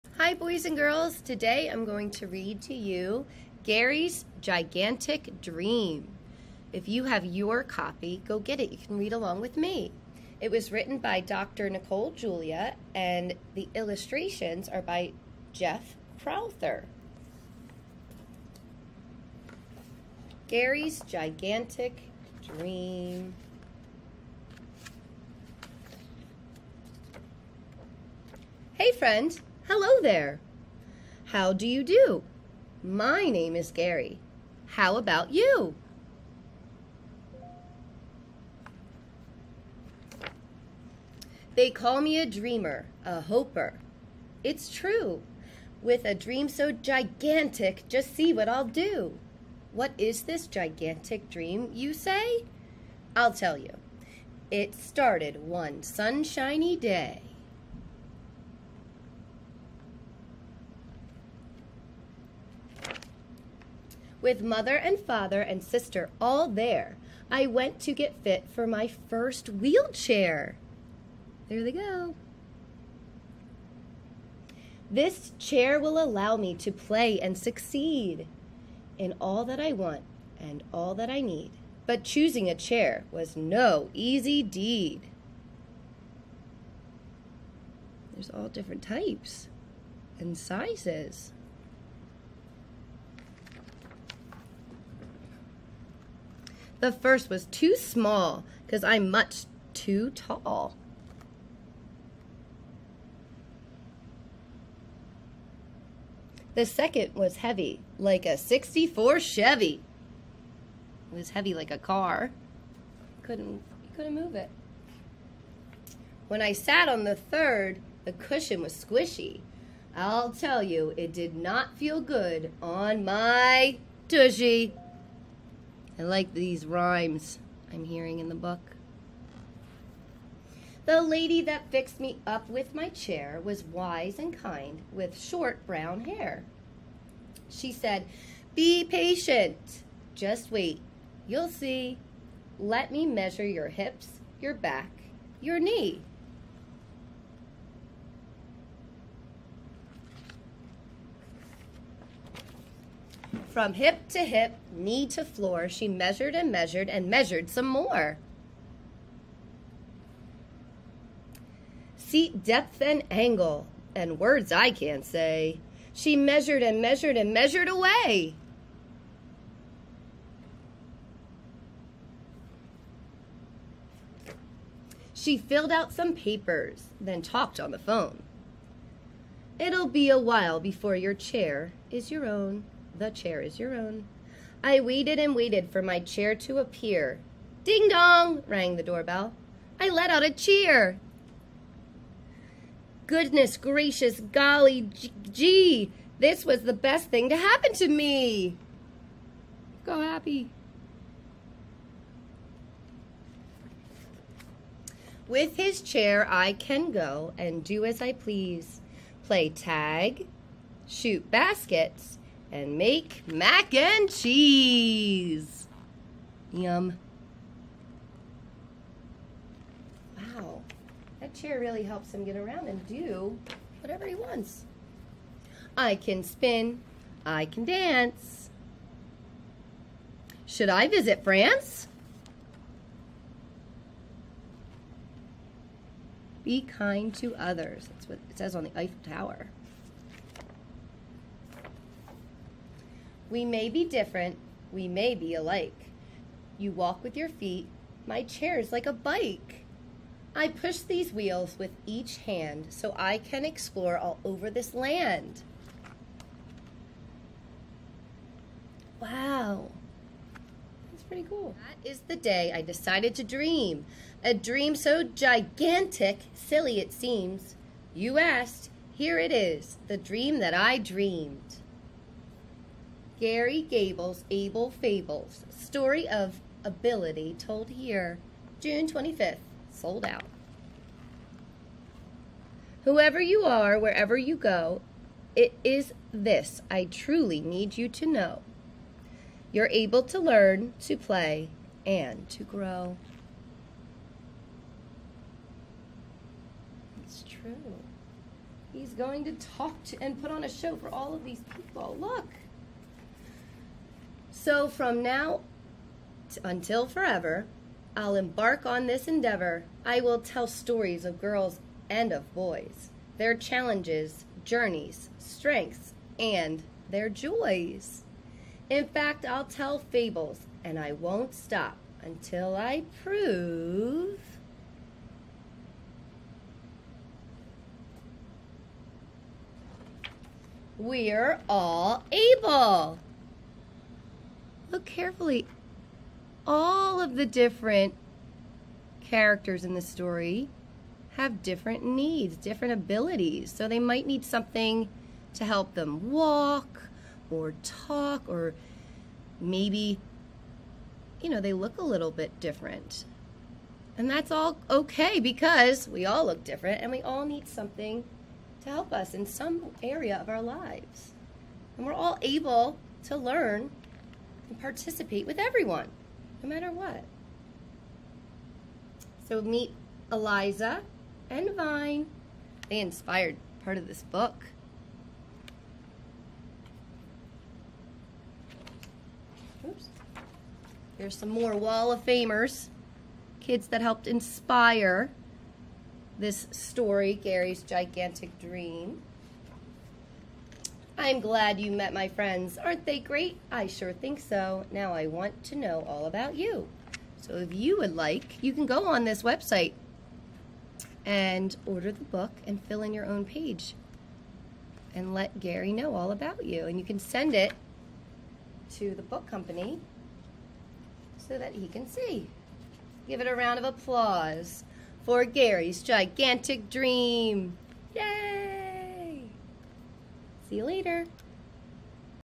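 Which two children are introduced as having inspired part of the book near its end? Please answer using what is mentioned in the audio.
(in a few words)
Eliza and Vine.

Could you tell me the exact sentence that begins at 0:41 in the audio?
They call me a dreamer, a hoper.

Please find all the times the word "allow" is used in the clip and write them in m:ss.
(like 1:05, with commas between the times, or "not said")
1:16.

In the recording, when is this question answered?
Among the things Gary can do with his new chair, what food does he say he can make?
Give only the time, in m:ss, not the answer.
3:33.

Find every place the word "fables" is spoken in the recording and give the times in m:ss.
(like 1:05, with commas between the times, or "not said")
4:34, 5:19.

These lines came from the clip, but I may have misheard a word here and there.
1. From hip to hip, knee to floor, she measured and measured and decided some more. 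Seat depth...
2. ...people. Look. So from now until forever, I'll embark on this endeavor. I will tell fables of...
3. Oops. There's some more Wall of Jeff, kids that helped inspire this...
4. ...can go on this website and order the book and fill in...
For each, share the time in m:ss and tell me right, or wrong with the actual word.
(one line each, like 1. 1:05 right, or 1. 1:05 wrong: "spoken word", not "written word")
1. 2:33 wrong: "measured", not "decided"
2. 5:01 wrong: "stories", not "fables"
3. 6:19 wrong: "Famers", not "Jeff"
4. 6:38 right.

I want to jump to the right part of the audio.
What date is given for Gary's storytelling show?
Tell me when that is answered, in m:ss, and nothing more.
4:38.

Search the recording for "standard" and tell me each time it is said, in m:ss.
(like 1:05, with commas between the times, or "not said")
not said.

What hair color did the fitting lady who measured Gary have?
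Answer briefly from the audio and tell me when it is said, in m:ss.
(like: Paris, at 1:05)
brown, at 2:15.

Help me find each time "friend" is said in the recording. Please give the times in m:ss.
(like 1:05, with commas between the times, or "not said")
0:28, 6:32.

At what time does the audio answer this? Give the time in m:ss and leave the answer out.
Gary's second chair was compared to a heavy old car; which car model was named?
1:48.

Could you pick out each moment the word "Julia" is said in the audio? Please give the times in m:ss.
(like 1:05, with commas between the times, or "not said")
0:12.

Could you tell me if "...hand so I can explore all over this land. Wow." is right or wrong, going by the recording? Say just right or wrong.
right.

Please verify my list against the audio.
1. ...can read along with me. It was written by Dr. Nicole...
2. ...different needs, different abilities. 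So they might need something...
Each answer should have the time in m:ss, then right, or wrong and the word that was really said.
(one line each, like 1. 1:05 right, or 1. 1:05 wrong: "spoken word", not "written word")
1. 0:08 right
2. 5:41 right.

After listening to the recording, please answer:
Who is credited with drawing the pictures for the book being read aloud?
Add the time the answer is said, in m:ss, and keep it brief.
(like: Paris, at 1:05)
Jeff Crowther, at 0:15.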